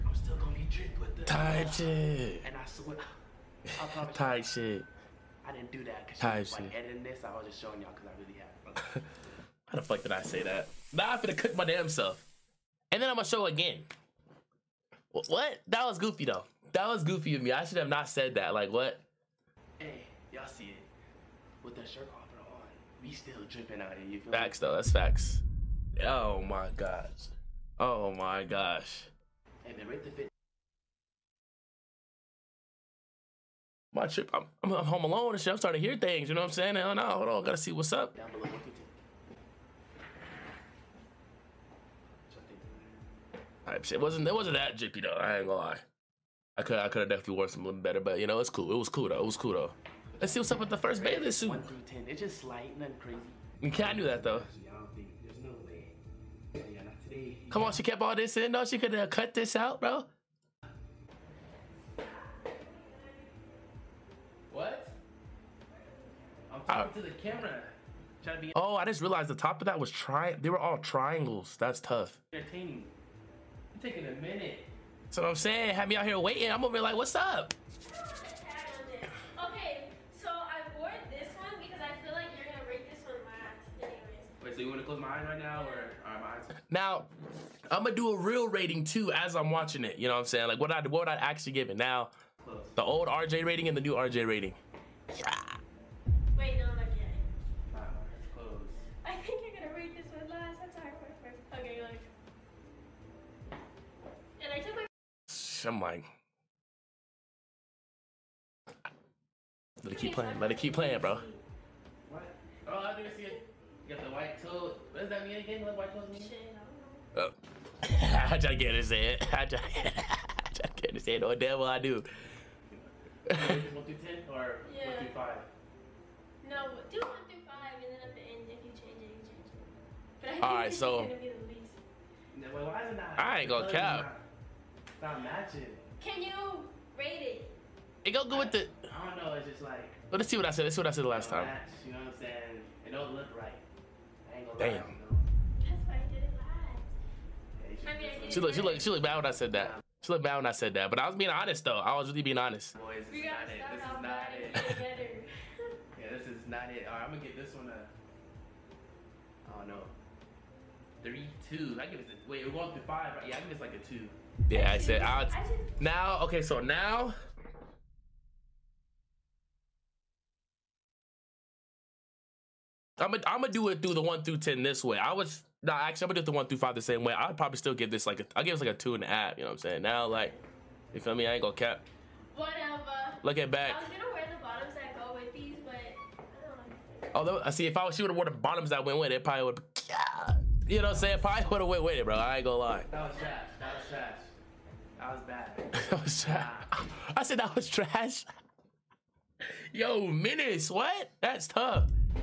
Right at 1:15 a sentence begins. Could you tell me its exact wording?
So I'm saying, have me out here waiting.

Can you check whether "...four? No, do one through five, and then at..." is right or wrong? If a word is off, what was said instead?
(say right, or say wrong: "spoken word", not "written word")
wrong: "five", not "four".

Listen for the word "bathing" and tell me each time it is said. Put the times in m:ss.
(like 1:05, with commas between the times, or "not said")
0:51.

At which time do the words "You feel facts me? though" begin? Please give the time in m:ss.
0:24.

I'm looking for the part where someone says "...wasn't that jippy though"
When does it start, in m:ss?
0:44.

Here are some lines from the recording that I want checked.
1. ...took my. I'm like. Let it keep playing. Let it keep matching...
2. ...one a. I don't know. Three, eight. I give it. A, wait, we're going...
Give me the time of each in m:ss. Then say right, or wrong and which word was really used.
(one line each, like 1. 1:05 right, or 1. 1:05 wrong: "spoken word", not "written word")
1. 1:44 wrong: "playing", not "matching"
2. 2:37 wrong: "two", not "eight".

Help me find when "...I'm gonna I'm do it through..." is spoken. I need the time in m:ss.
2:52.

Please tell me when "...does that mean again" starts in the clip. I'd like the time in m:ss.
1:54.